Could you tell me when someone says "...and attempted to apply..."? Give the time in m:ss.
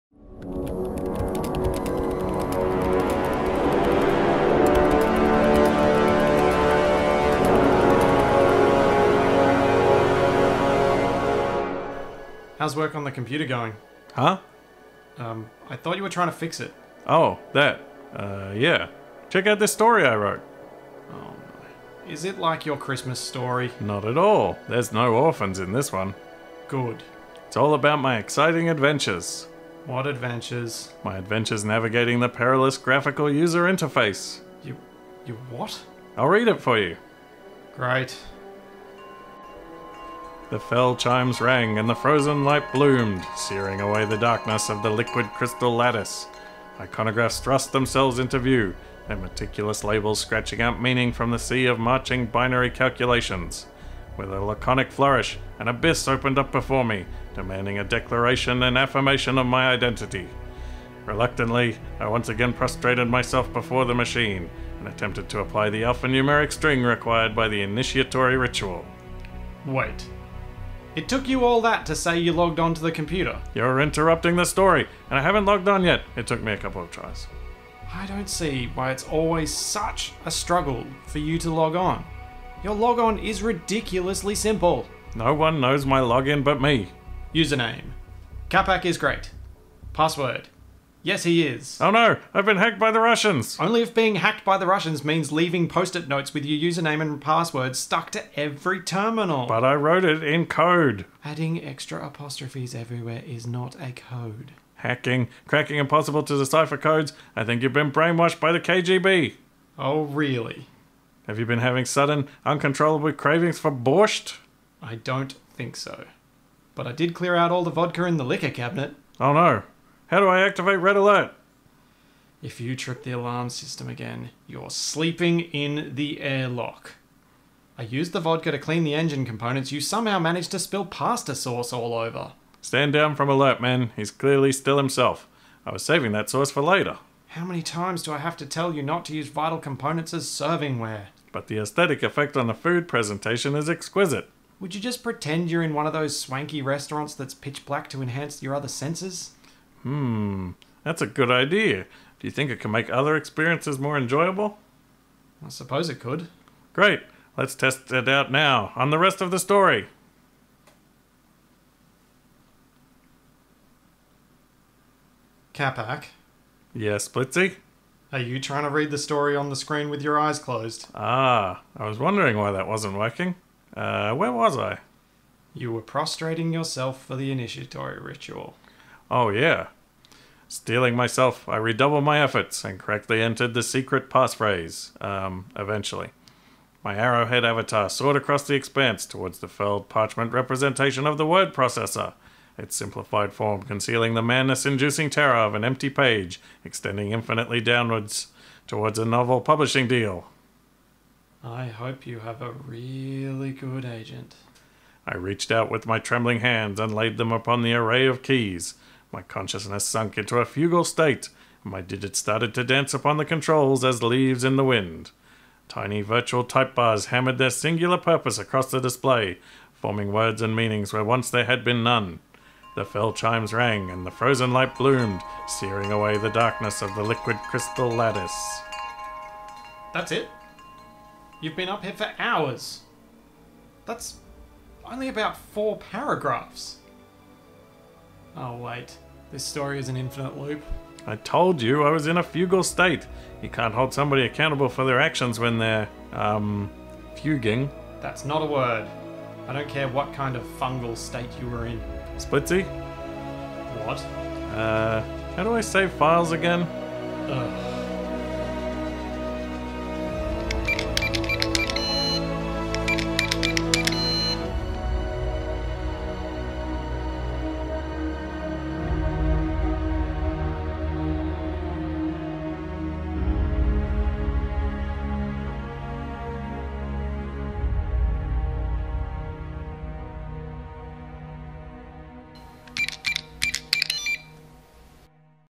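1:04.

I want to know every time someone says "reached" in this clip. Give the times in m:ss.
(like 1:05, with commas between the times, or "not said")
3:25.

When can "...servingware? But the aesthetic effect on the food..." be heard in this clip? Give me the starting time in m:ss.
2:20.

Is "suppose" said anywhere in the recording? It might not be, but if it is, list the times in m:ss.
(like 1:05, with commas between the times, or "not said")
2:35.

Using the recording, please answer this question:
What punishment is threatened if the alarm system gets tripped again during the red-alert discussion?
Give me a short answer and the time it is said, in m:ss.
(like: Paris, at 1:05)
Sleeping in the airlock, at 2:04.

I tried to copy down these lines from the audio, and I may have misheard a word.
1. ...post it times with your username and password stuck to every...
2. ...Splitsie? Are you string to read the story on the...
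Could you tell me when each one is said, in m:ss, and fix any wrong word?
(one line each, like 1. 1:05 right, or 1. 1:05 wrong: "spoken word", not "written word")
1. 1:35 wrong: "notes", not "times"
2. 2:47 wrong: "trying", not "string".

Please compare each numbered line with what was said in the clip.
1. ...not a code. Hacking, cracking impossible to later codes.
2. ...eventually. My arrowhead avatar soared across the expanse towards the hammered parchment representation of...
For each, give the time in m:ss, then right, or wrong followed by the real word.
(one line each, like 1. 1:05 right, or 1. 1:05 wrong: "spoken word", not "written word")
1. 1:43 wrong: "decipher", not "later"
2. 3:05 wrong: "felled", not "hammered".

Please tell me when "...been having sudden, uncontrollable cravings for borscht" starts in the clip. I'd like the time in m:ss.
1:51.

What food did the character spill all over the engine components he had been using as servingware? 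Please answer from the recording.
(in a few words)
Pasta sauce.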